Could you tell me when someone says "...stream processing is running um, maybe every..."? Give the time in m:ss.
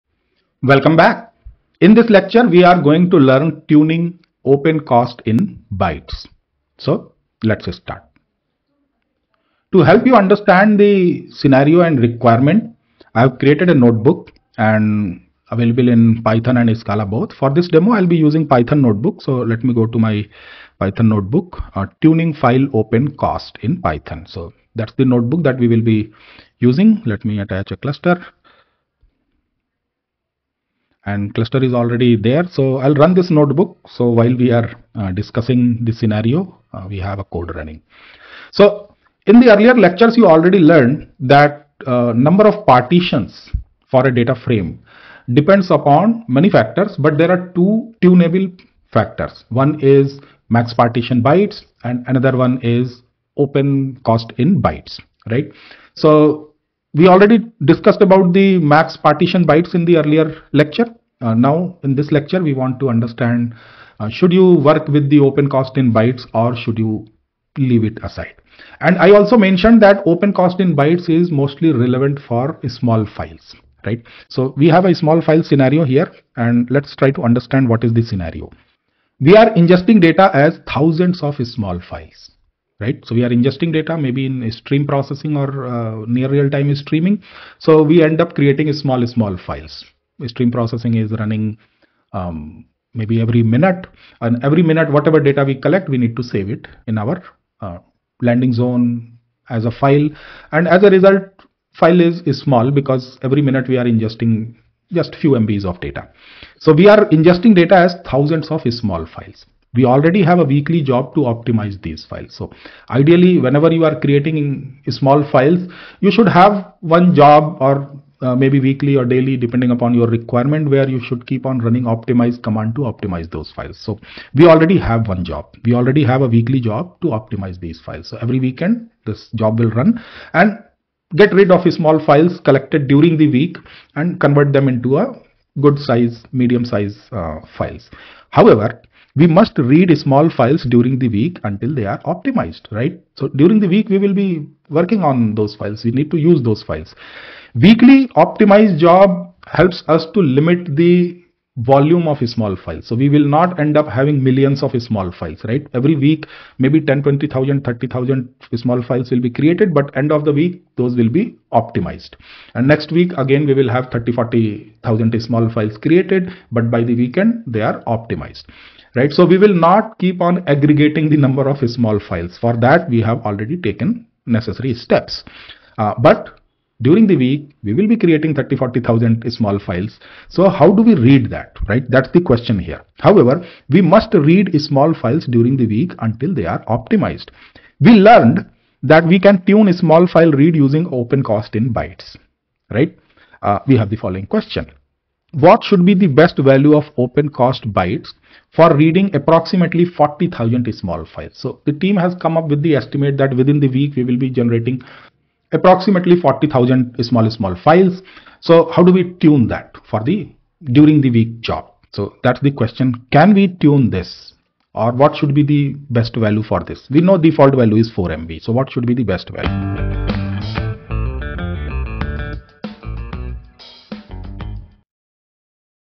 1:30.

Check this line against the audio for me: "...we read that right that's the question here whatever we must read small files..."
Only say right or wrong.
wrong.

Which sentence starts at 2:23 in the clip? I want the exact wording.
So during the week, we will be working on those files.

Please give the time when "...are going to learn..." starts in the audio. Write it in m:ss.
0:02.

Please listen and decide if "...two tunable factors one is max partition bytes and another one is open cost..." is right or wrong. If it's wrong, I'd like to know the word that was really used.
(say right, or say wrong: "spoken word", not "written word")
right.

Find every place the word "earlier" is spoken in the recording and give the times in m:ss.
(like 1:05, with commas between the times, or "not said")
0:39, 0:59.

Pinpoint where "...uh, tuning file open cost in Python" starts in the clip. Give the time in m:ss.
0:21.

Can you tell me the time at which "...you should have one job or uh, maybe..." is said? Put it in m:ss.
1:56.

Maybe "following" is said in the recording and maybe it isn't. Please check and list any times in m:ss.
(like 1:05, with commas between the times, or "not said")
3:14.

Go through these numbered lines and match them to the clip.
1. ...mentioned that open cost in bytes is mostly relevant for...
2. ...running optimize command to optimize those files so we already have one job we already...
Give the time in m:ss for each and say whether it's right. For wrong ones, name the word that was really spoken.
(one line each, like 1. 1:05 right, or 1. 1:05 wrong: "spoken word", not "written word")
1. 1:09 right
2. 2:01 right.